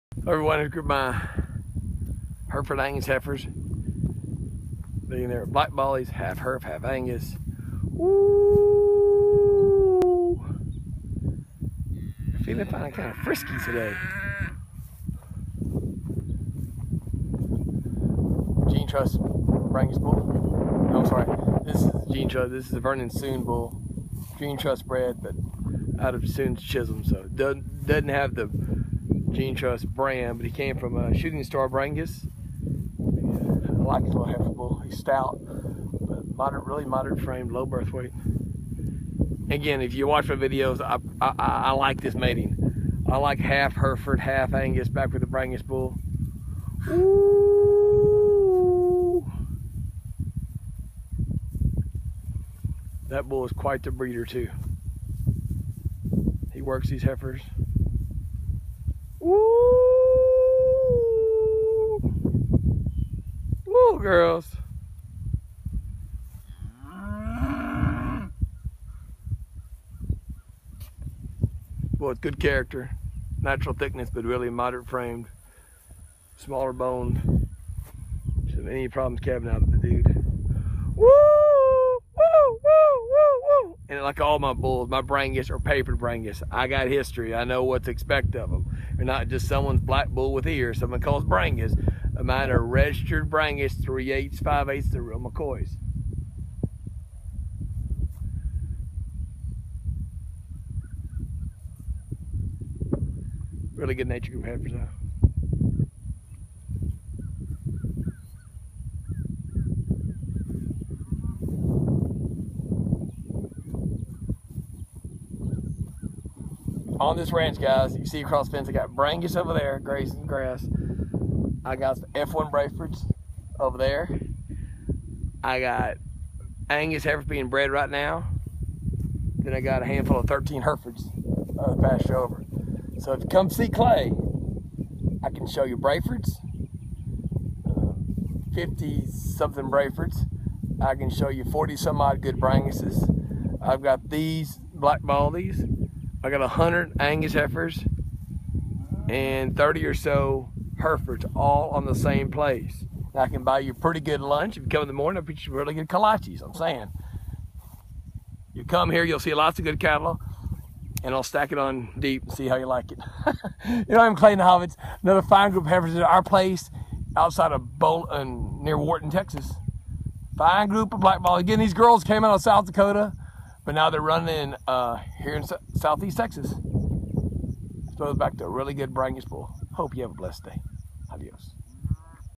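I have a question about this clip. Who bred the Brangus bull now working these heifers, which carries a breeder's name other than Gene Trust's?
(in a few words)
Vernon Suhn.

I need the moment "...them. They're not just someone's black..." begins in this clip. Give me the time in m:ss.
1:28.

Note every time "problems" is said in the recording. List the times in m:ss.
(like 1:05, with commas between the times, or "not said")
1:18.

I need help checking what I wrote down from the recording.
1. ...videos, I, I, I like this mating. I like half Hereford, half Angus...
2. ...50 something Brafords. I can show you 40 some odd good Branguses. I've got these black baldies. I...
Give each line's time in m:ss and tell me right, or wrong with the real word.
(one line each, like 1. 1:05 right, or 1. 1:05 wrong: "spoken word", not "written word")
1. 0:40 right
2. 2:18 right.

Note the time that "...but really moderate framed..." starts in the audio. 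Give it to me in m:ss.
1:14.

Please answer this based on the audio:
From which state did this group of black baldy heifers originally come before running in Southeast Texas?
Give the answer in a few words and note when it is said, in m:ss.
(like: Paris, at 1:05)
South Dakota, at 2:52.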